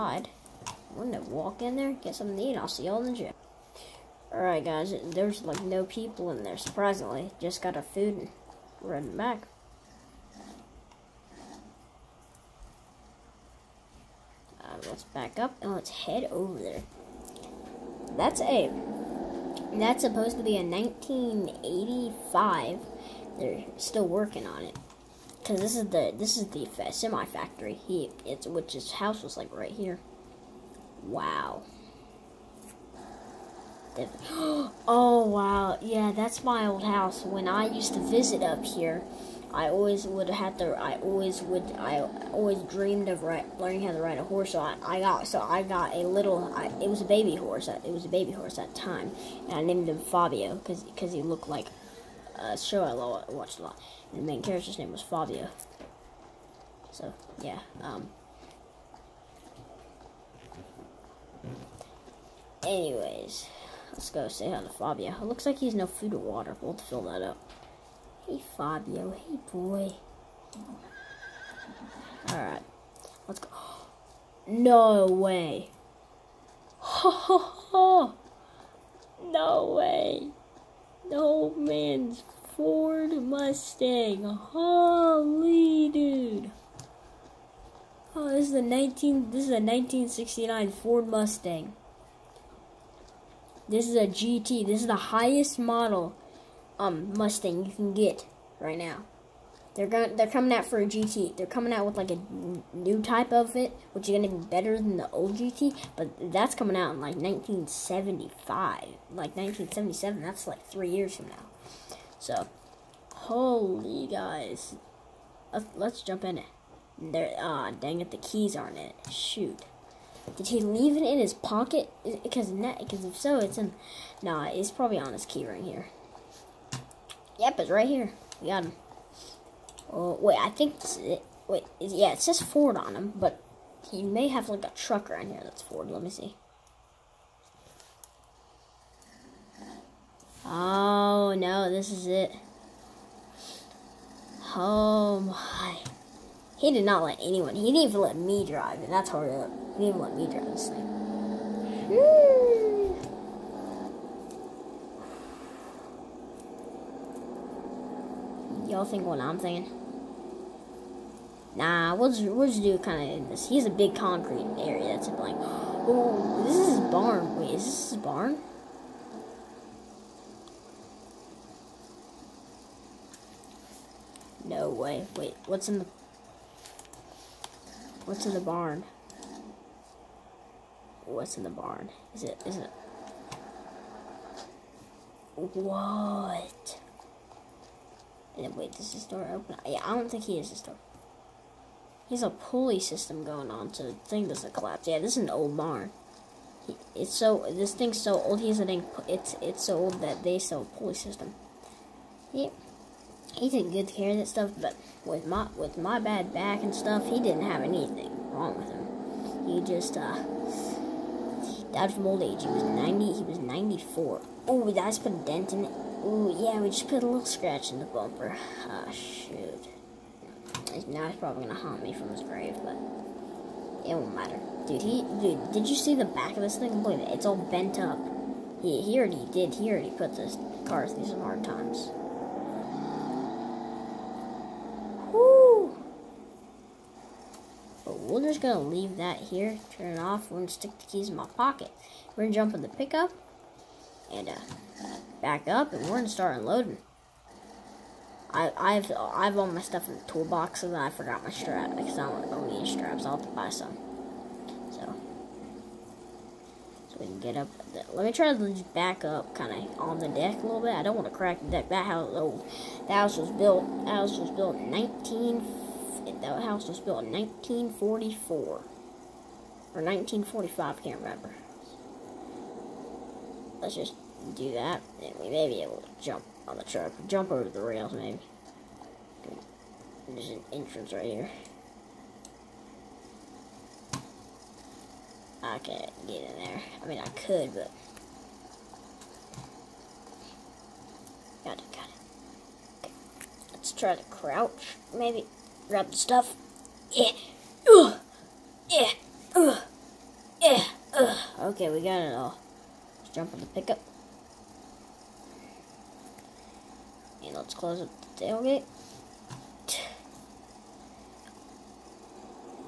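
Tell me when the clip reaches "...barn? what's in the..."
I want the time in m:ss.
2:58.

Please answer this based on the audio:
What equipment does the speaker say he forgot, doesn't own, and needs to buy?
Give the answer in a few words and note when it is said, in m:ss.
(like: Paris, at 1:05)
Straps, at 4:11.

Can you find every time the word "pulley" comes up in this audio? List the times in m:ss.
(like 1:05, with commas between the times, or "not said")
3:12, 3:20.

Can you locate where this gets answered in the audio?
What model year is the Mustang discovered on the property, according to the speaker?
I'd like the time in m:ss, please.
1:29.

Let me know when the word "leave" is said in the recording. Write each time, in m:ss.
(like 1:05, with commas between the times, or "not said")
2:00, 3:58.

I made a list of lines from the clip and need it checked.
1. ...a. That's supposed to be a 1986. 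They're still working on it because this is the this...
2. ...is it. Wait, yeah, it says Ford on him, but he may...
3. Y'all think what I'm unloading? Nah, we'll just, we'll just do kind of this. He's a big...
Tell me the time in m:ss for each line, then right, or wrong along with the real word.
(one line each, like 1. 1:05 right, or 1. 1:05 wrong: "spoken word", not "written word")
1. 0:18 wrong: "1985", not "1986"
2. 2:10 right
3. 2:38 wrong: "thinking", not "unloading".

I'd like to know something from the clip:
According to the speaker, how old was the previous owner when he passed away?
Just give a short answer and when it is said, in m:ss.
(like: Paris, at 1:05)
94, at 3:33.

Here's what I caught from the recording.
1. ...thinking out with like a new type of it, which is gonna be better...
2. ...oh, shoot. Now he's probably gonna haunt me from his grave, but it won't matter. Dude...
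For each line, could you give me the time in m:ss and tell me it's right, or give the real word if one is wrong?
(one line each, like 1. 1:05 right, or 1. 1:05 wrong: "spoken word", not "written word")
1. 1:41 wrong: "coming", not "thinking"
2. 3:38 right.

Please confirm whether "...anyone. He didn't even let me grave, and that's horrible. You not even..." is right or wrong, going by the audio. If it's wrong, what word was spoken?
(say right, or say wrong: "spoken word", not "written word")
wrong: "drive", not "grave".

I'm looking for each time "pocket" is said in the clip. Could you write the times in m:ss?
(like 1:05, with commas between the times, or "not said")
2:01, 4:01.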